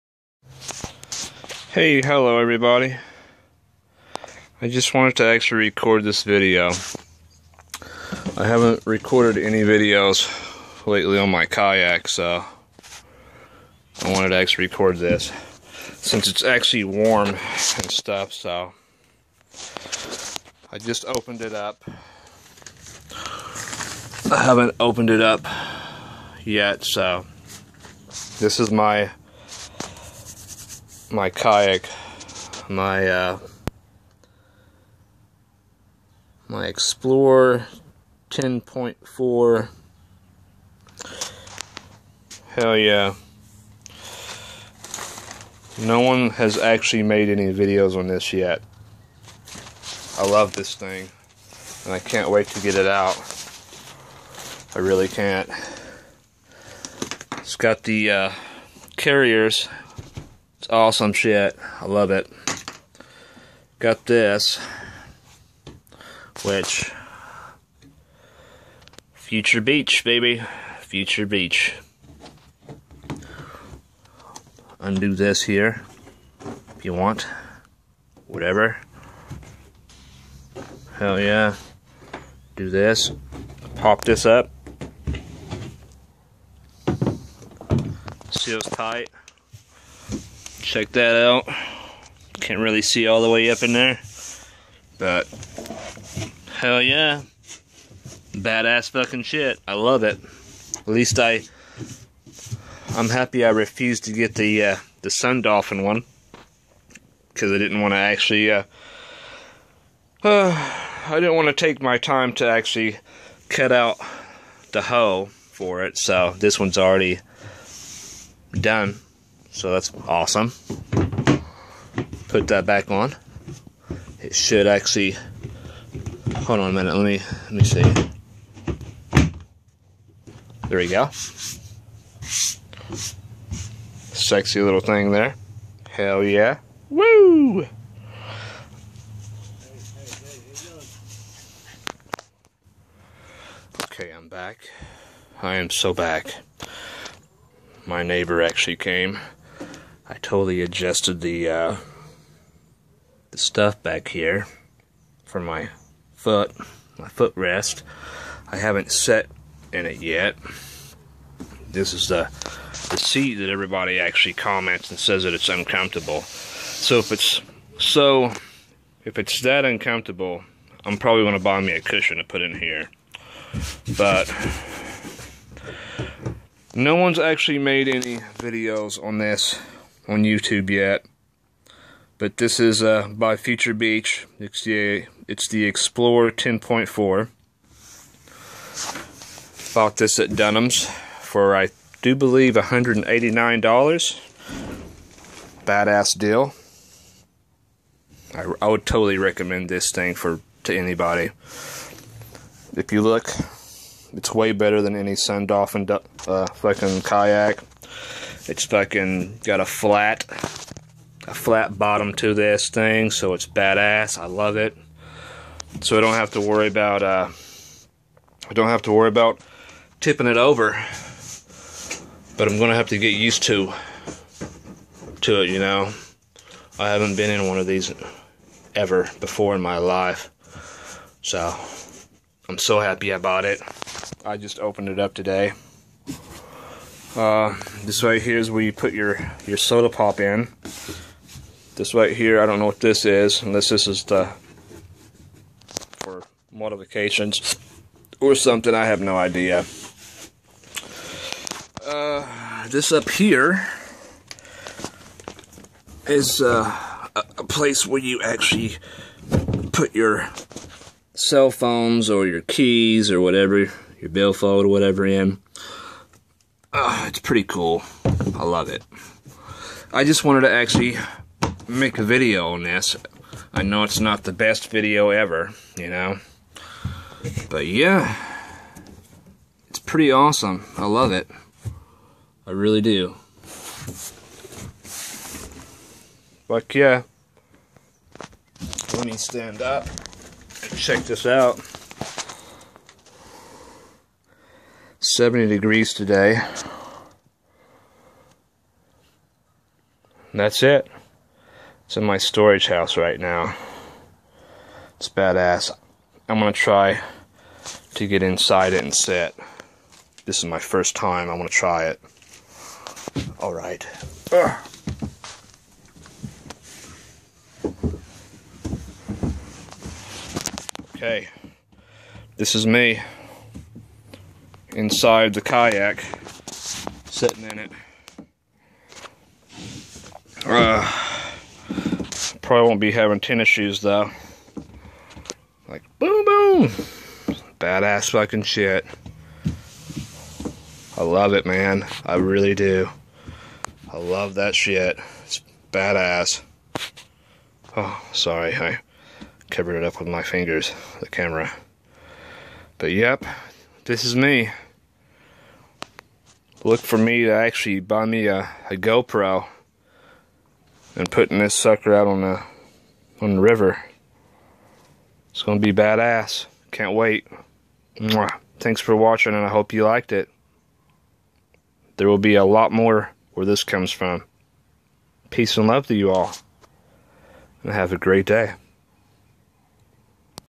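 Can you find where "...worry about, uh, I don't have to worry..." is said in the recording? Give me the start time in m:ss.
3:36.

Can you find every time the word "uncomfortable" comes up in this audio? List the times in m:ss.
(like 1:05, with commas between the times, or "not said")
2:45, 2:49.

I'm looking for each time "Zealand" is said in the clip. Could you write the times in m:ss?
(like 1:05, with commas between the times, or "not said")
not said.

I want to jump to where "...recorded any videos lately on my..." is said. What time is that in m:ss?
0:08.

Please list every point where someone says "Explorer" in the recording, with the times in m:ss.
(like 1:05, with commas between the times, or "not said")
0:36, 3:05.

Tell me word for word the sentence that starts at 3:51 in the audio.
So I'm so happy I bought it.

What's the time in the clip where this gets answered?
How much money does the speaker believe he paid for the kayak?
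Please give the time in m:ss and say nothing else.
3:12.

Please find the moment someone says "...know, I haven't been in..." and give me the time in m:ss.
3:45.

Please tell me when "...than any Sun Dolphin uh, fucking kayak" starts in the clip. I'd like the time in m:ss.
3:24.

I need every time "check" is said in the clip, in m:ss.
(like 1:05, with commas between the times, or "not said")
1:30, 4:50.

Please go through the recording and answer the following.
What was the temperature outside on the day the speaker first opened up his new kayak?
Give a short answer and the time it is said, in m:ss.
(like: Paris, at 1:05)
70 degrees, at 4:55.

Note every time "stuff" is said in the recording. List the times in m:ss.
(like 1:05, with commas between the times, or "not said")
0:17, 2:33.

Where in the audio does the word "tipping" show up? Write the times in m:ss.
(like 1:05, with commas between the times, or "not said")
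3:39.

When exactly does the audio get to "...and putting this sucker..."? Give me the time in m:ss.
6:00.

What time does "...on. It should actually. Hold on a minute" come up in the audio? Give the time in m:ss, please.
2:02.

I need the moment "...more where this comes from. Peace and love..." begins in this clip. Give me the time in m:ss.
6:12.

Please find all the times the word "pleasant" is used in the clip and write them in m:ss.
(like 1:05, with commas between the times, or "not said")
not said.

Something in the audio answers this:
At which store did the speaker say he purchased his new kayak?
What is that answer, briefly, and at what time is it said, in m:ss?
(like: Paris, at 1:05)
Dunham's, at 3:10.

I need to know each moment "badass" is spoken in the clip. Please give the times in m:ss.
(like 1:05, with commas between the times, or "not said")
1:38, 3:15, 3:33, 5:05, 5:37, 5:45, 6:05.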